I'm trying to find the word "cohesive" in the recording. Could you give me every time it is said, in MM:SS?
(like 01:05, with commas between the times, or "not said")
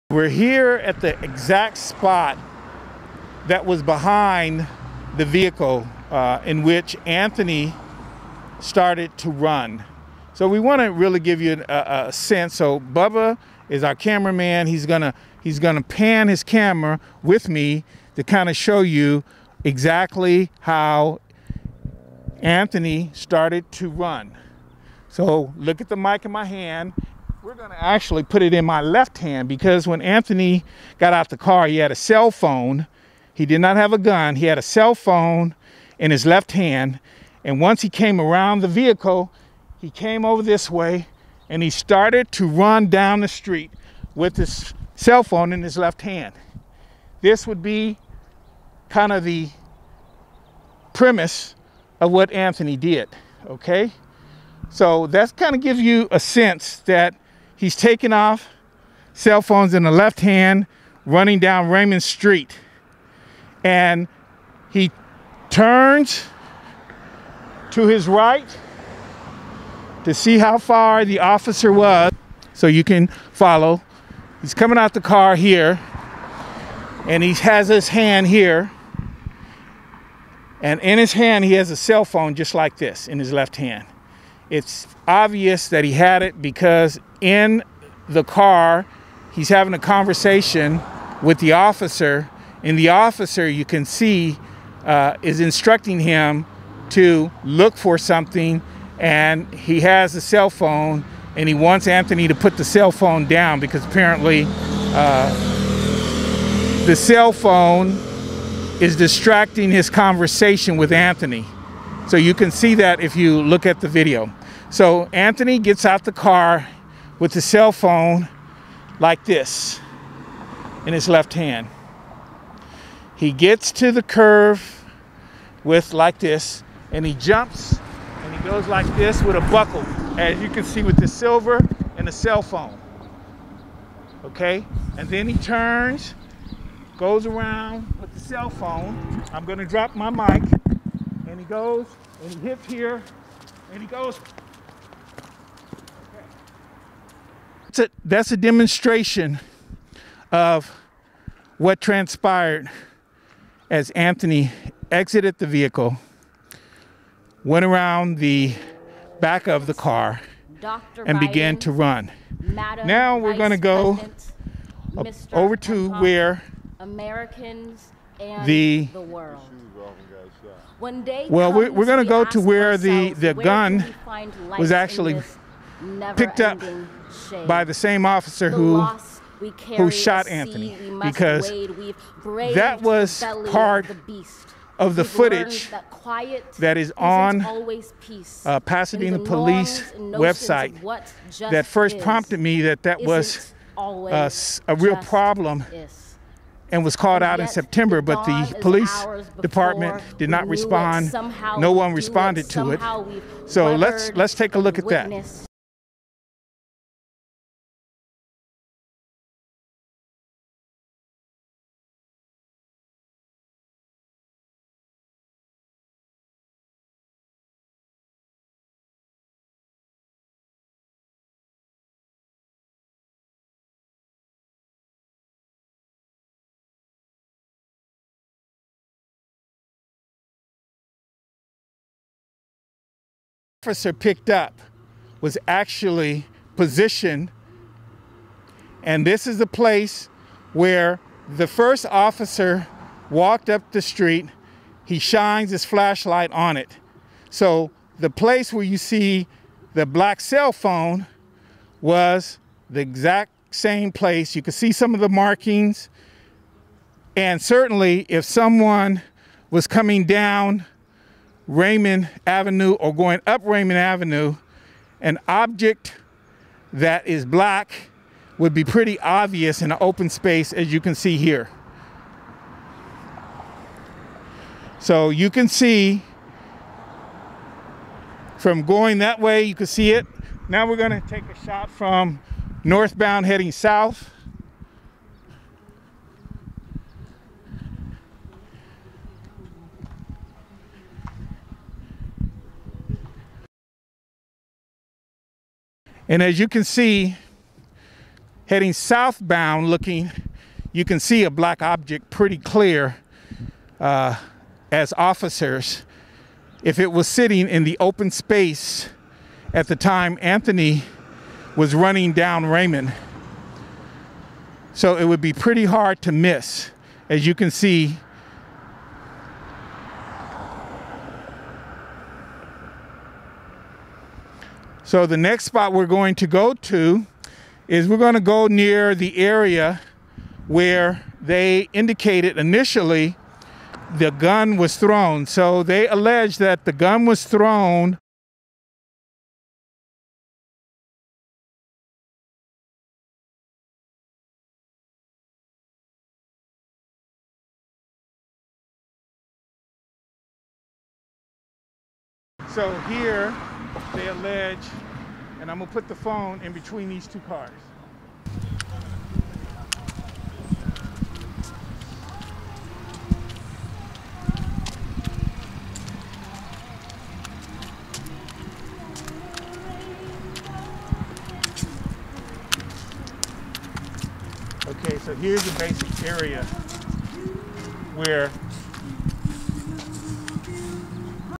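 not said.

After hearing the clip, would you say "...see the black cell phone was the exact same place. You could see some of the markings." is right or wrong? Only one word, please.
right.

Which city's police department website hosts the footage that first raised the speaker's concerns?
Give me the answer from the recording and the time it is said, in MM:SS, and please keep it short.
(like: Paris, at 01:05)
Pasadena, at 03:08.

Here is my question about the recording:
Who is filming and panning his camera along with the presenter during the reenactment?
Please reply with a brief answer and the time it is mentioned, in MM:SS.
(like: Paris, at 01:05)
Bubba, at 00:12.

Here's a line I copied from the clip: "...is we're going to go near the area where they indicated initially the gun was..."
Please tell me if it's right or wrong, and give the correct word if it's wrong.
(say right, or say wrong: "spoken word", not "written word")
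right.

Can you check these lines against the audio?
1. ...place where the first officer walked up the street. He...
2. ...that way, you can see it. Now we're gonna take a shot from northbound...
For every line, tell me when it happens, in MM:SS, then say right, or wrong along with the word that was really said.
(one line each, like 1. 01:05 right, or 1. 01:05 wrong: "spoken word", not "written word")
1. 03:59 right
2. 04:38 right.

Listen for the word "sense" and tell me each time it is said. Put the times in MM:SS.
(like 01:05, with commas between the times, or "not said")
00:12, 00:56.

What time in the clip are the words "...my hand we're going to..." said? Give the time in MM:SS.
00:26.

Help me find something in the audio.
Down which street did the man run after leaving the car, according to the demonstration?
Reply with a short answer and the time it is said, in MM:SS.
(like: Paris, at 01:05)
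Raymond Street, at 01:01.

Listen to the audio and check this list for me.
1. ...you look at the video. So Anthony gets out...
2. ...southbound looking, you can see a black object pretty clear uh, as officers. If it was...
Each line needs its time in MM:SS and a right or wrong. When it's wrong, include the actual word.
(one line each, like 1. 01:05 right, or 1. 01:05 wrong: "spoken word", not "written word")
1. 01:53 right
2. 04:58 right.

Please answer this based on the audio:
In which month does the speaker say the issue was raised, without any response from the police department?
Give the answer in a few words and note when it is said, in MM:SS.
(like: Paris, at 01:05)
September, at 03:17.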